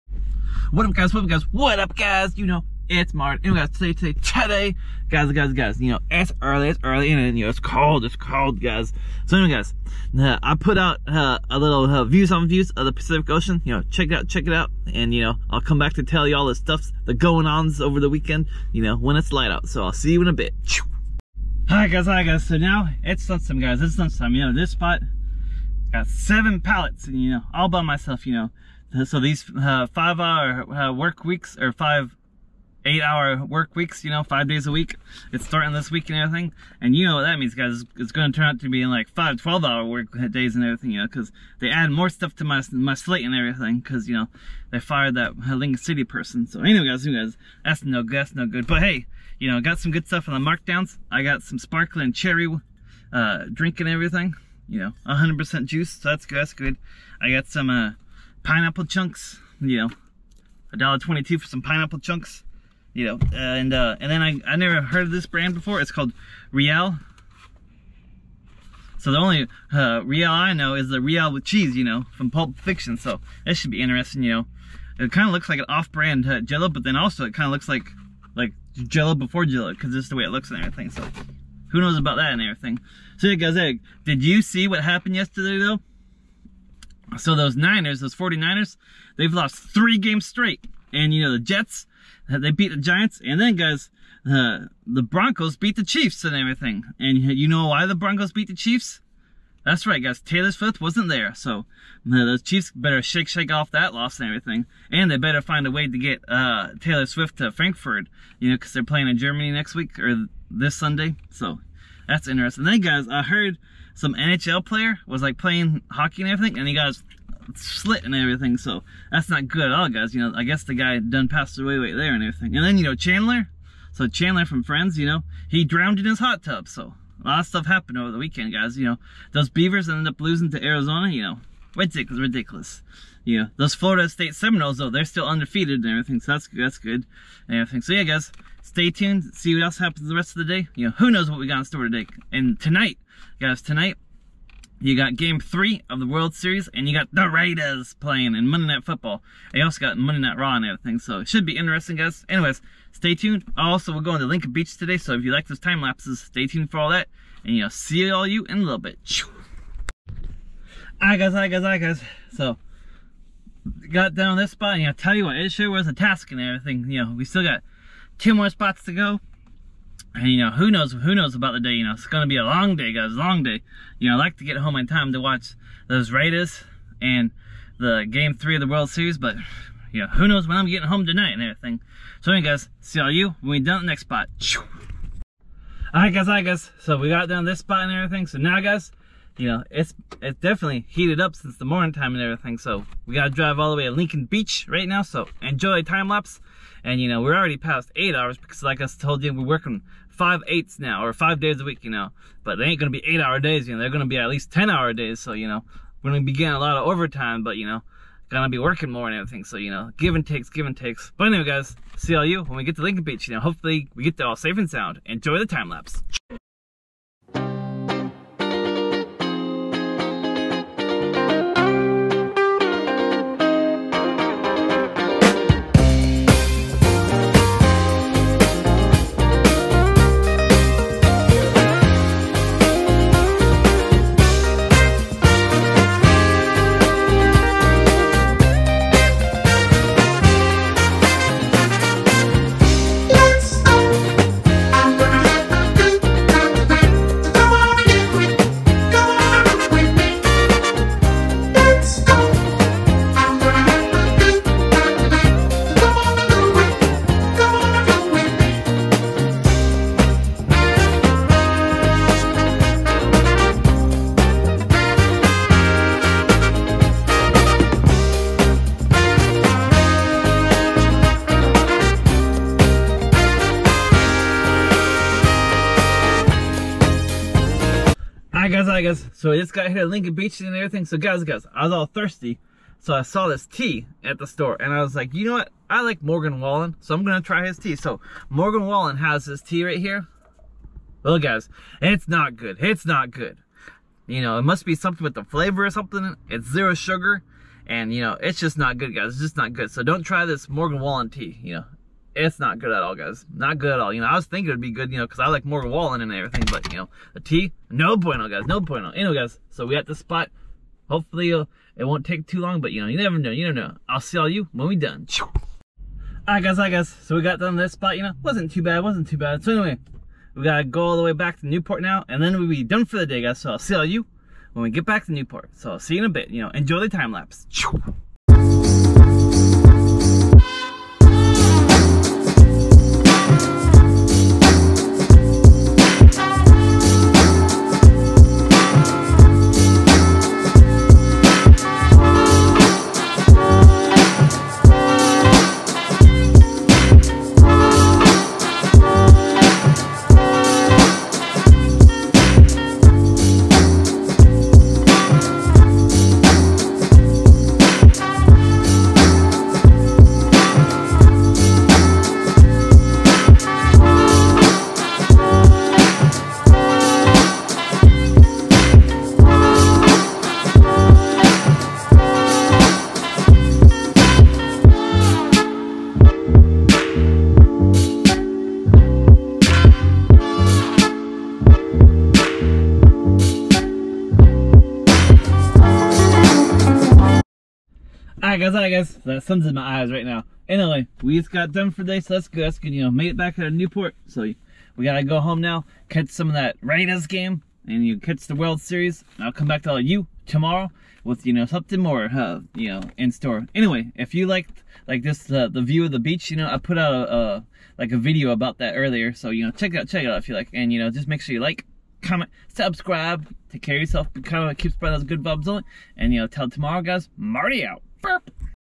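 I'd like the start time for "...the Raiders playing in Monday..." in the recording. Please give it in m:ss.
2:27.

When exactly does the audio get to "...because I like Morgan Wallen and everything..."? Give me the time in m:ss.
5:05.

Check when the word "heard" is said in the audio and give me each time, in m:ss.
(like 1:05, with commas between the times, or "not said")
1:04, 1:53.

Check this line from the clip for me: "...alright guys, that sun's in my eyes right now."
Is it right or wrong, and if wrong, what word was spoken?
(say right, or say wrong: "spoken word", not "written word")
right.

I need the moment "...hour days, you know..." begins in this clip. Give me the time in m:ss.
3:23.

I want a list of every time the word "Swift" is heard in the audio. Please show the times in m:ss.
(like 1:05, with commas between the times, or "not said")
1:40, 1:47.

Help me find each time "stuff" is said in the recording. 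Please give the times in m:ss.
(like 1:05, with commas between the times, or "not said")
0:16, 0:42, 0:50, 2:07.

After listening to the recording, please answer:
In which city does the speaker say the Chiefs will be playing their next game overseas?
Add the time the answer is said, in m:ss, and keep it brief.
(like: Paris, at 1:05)
Frankfurt, at 1:47.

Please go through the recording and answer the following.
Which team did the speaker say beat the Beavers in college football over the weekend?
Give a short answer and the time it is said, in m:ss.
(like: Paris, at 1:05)
Arizona, at 2:10.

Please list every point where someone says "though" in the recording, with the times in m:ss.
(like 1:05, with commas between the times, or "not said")
1:25, 2:14.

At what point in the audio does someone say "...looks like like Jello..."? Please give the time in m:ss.
1:17.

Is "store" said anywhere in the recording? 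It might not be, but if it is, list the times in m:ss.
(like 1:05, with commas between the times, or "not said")
2:21, 4:44, 6:43.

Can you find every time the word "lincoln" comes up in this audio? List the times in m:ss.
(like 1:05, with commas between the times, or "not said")
0:45, 2:34, 3:13, 3:32, 4:39.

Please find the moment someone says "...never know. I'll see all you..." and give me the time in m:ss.
5:13.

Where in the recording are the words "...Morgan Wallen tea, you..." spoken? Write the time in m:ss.
5:00.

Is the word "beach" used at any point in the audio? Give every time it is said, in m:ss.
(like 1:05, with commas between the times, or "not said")
2:34, 3:14, 3:33, 4:40, 6:45.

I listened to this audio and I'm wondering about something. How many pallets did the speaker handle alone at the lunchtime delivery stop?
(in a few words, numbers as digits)
7.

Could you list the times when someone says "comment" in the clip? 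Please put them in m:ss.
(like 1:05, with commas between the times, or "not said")
6:52.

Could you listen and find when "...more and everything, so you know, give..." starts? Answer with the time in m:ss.
3:28.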